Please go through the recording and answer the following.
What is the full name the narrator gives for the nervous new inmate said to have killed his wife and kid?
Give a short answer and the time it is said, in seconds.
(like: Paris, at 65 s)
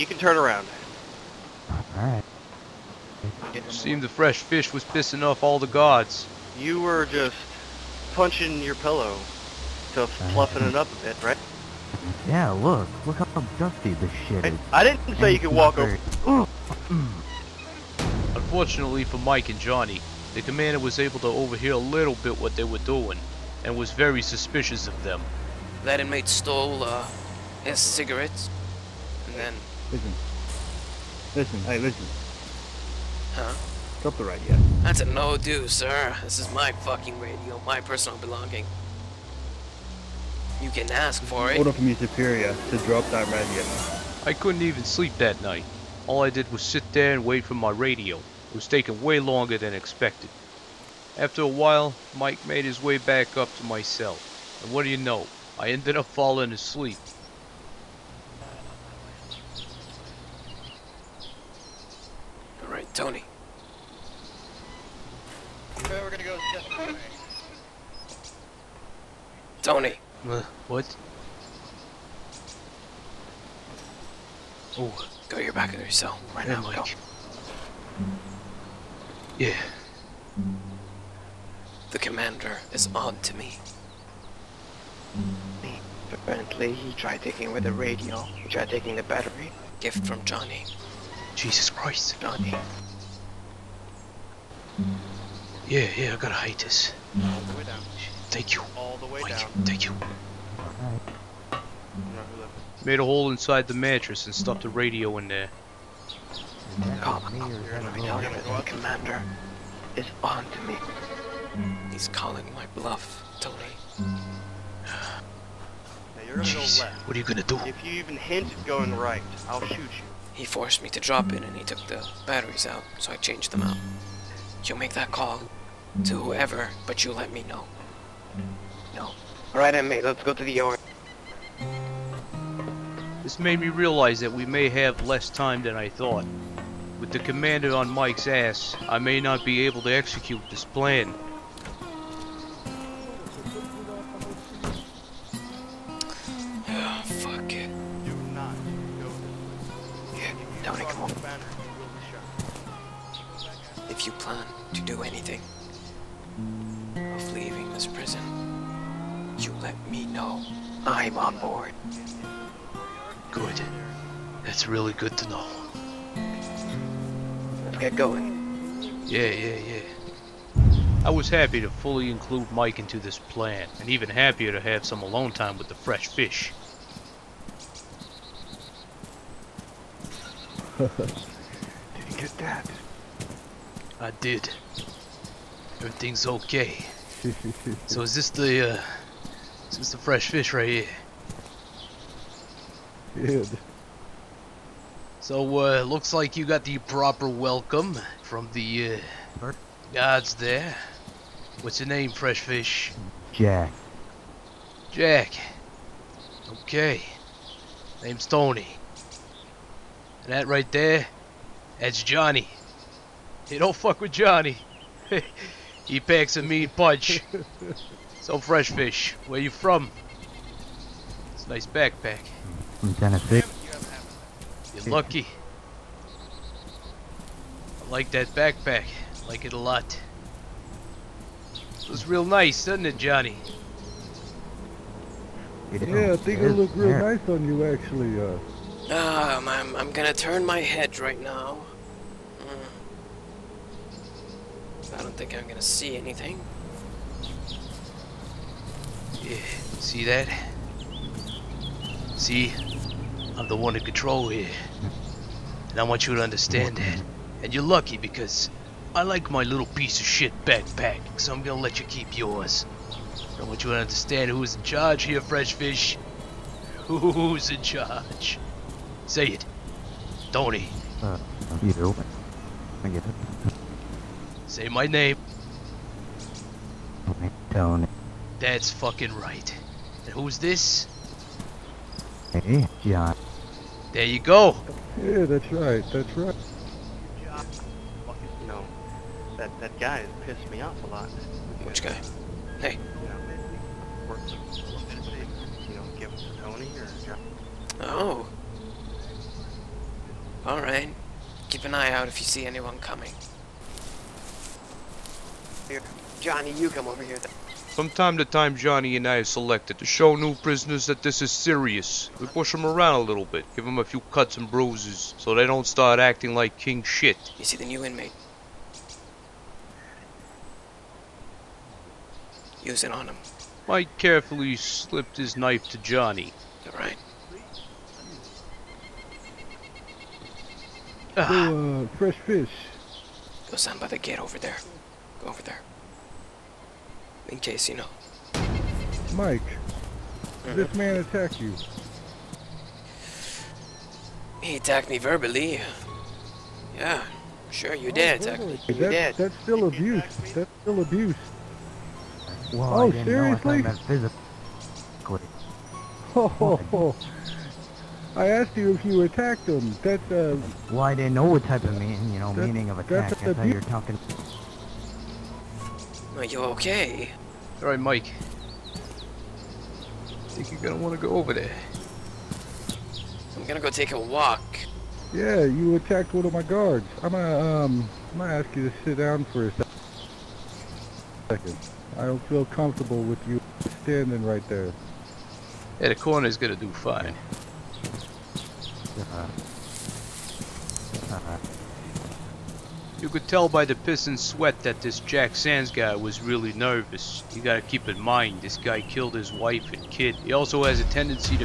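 Jack Sands, at 395 s.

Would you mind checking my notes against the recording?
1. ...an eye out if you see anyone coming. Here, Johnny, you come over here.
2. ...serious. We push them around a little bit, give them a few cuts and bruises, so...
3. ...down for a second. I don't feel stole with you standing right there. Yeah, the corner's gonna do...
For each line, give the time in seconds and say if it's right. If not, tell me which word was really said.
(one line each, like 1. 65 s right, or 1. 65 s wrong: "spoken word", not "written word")
1. 301 s right
2. 311 s right
3. 378 s wrong: "comfortable", not "stole".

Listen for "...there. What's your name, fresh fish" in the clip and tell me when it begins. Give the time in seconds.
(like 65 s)
200 s.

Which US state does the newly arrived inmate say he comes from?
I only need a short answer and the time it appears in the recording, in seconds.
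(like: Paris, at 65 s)
Tennessee, at 222 s.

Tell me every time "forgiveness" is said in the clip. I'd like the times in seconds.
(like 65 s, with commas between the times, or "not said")
not said.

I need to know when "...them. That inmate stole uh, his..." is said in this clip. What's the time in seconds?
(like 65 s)
25 s.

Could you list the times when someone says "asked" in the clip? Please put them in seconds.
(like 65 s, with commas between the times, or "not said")
358 s.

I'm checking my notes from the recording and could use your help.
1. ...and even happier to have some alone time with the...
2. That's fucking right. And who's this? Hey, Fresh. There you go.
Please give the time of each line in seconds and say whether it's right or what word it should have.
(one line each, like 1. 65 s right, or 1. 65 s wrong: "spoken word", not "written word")
1. 173 s right
2. 278 s wrong: "John", not "Fresh".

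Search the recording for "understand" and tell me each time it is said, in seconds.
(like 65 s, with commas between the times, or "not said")
256 s, 263 s.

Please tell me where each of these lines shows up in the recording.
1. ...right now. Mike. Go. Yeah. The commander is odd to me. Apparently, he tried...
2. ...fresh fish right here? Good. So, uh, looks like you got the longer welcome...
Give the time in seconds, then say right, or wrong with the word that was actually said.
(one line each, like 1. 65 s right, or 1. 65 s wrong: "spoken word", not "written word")
1. 76 s right
2. 189 s wrong: "proper", not "longer".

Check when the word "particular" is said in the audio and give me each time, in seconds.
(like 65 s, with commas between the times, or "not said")
not said.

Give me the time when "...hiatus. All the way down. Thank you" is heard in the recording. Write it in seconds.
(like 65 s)
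96 s.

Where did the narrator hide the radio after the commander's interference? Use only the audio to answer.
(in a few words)
Inside the mattress.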